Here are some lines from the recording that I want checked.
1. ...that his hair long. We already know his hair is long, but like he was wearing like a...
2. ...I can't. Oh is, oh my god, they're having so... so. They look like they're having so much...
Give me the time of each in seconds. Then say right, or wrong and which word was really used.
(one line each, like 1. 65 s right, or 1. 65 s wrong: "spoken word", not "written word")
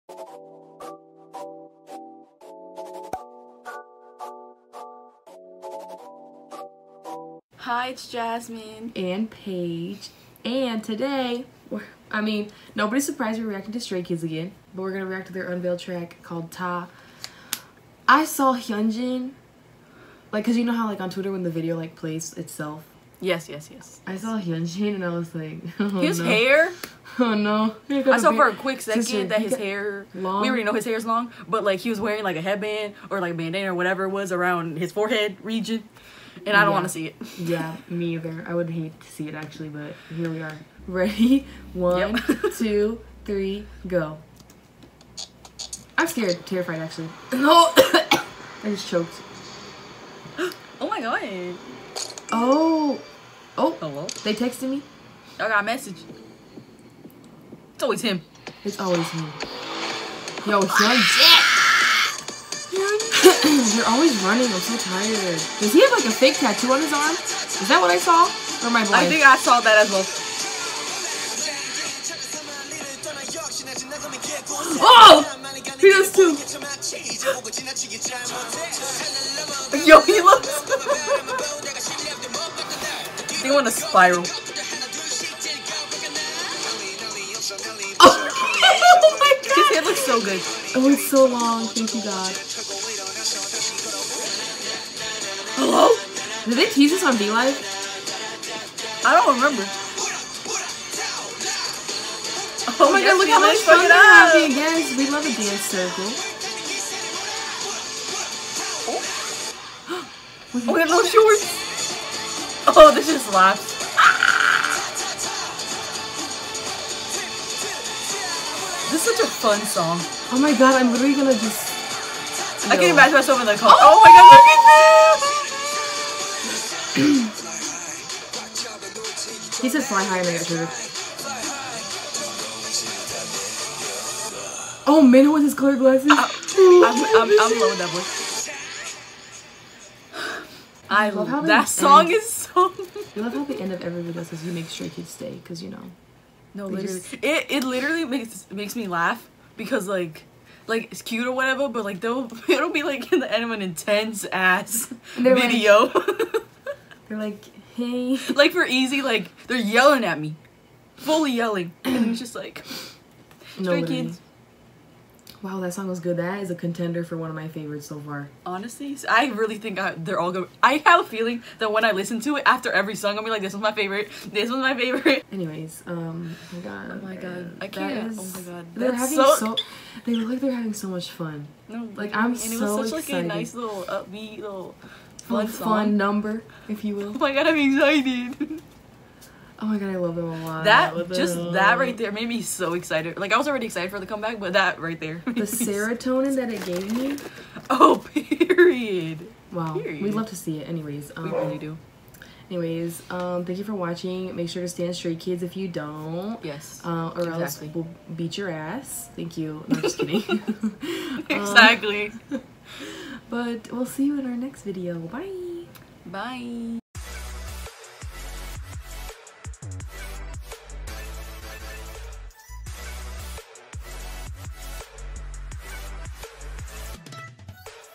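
1. 29 s right
2. 177 s right.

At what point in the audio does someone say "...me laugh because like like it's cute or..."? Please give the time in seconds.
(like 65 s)
148 s.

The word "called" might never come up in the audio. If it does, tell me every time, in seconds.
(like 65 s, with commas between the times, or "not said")
16 s.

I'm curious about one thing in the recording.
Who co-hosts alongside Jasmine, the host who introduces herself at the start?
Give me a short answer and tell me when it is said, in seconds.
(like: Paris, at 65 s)
Paige, at 9 s.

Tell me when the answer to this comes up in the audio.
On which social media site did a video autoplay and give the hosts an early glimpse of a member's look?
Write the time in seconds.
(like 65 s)
21 s.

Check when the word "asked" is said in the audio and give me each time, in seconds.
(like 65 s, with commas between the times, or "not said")
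not said.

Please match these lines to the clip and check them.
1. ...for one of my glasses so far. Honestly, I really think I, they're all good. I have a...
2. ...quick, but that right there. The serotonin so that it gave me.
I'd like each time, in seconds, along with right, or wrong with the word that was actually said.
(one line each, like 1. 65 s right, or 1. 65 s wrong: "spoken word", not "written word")
1. 167 s wrong: "favorites", not "glasses"
2. 194 s wrong: "comeback", not "quick".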